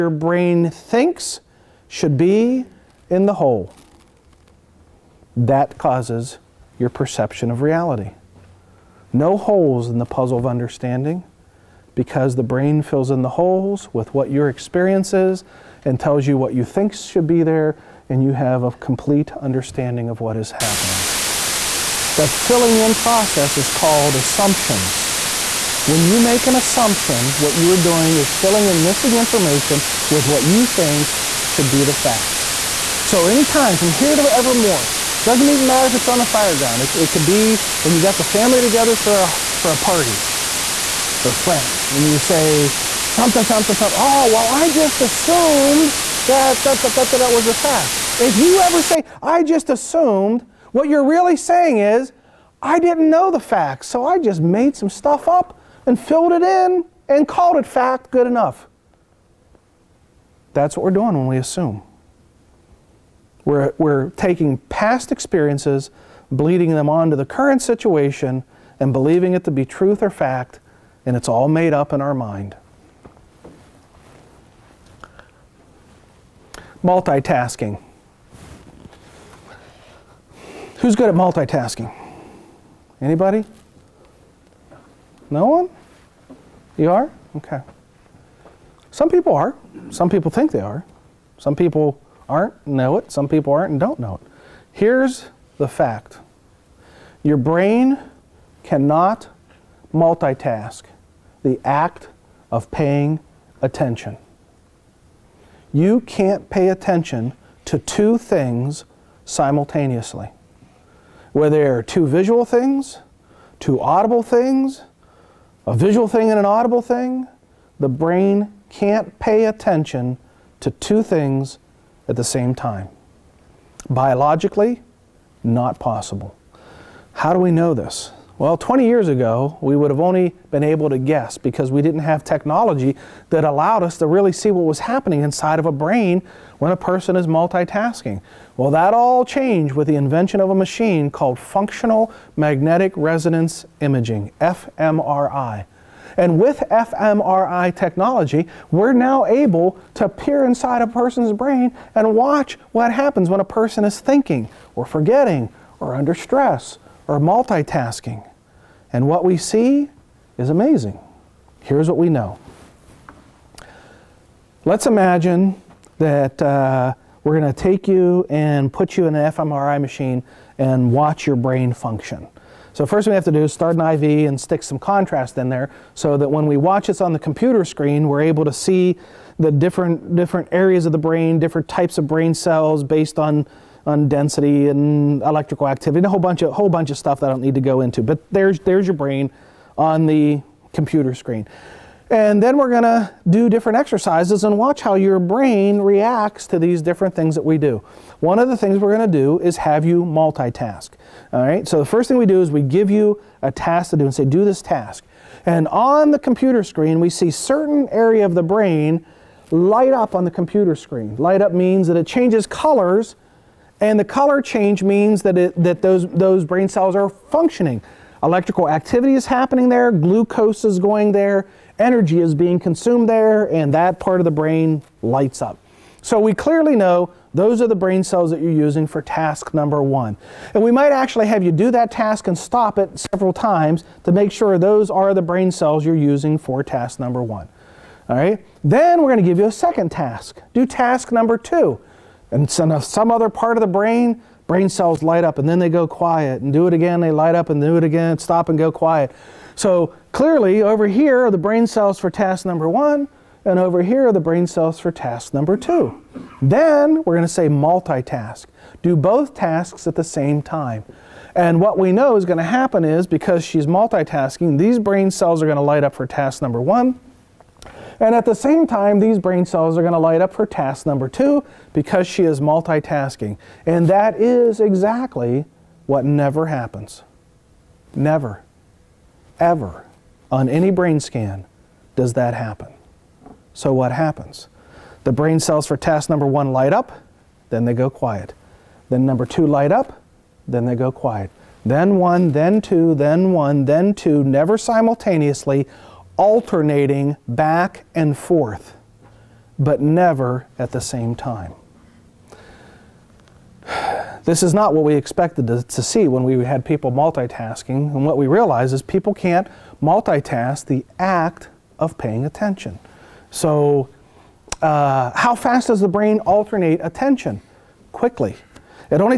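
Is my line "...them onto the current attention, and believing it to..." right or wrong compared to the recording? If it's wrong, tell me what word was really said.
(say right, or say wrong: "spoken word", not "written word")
wrong: "situation", not "attention".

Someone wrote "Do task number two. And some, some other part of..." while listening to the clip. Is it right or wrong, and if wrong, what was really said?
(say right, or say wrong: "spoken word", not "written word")
right.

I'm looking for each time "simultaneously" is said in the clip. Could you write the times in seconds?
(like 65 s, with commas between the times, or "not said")
109 s, 294 s.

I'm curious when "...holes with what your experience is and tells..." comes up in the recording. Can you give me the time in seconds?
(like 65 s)
13 s.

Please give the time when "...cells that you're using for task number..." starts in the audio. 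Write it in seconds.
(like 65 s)
228 s.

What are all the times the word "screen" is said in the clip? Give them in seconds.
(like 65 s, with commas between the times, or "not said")
177 s, 191 s, 206 s, 210 s.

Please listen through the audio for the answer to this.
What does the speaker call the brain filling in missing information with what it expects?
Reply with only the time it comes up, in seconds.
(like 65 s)
24 s.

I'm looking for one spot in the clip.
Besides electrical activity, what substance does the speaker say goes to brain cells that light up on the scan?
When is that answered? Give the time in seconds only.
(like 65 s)
219 s.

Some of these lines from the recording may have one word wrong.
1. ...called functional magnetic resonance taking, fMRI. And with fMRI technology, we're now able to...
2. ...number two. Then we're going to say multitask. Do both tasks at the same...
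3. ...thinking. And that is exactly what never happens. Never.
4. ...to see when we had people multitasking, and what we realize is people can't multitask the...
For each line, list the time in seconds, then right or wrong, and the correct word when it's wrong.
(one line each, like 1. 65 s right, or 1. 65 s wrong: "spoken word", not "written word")
1. 141 s wrong: "imaging", not "taking"
2. 255 s right
3. 272 s wrong: "multitasking", not "thinking"
4. 305 s right.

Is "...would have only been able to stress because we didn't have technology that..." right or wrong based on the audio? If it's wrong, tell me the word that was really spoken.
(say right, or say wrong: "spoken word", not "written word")
wrong: "guess", not "stress".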